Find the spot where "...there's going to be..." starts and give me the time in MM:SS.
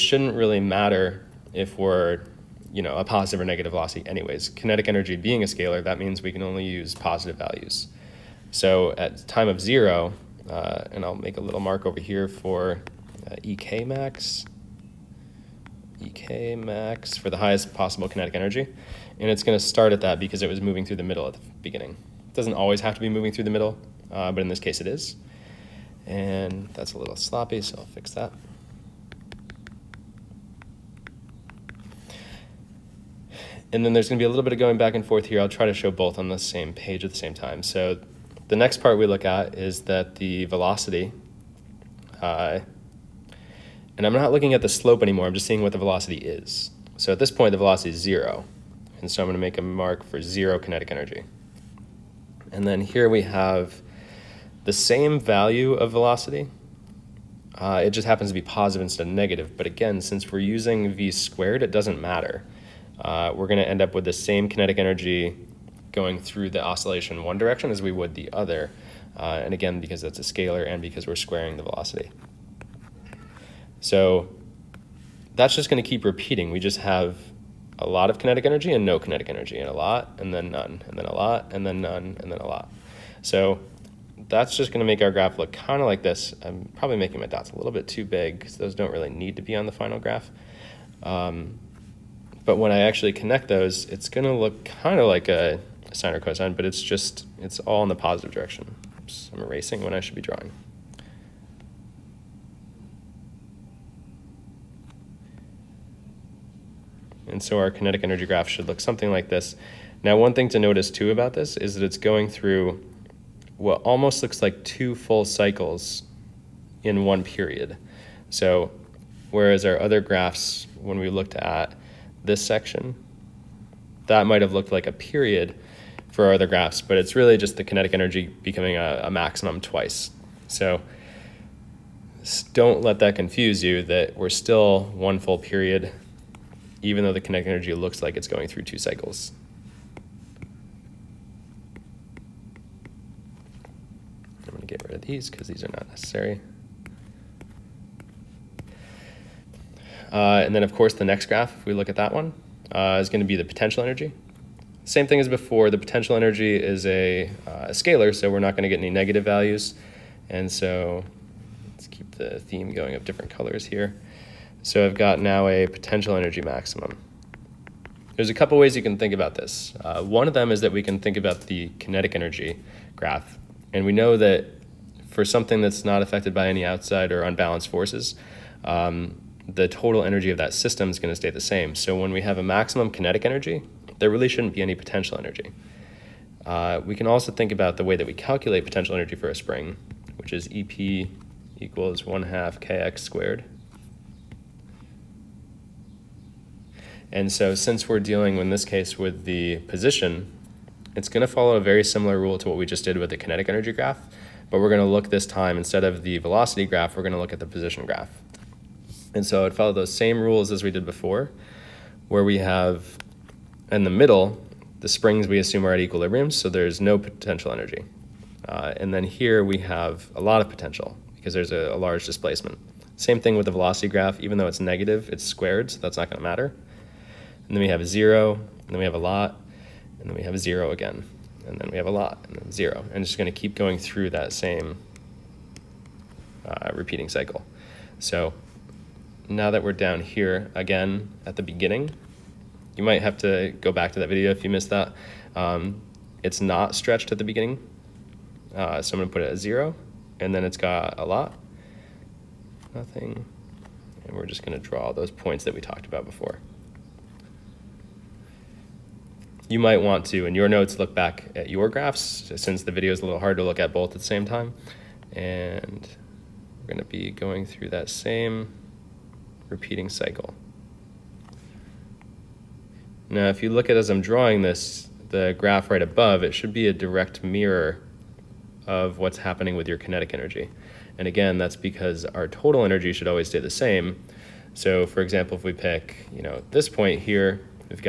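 00:33.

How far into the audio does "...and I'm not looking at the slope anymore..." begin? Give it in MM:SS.
00:43.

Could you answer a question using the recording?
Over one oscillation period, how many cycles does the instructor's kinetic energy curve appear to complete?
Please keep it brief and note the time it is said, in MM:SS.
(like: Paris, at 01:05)
2, at 01:54.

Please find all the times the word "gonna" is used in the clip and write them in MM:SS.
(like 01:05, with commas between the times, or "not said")
00:49, 01:03, 03:53, 04:09, 04:14.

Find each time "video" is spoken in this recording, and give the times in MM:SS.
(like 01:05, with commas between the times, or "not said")
04:04, 04:22.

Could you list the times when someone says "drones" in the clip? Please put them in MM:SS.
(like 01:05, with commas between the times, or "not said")
not said.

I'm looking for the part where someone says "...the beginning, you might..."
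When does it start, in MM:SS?
04:01.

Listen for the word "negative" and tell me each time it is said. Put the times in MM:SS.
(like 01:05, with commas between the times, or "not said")
00:03, 00:59, 02:38, 03:44.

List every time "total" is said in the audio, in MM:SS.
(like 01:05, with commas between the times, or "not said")
02:59, 04:42.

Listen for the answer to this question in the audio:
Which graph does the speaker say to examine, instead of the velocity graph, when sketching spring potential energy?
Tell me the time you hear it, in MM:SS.
03:27.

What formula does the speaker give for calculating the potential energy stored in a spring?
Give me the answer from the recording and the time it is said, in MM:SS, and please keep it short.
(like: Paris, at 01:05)
EP = 1/2 kx^2, at 03:10.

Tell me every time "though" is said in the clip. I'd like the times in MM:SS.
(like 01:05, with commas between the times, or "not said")
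02:17, 03:44.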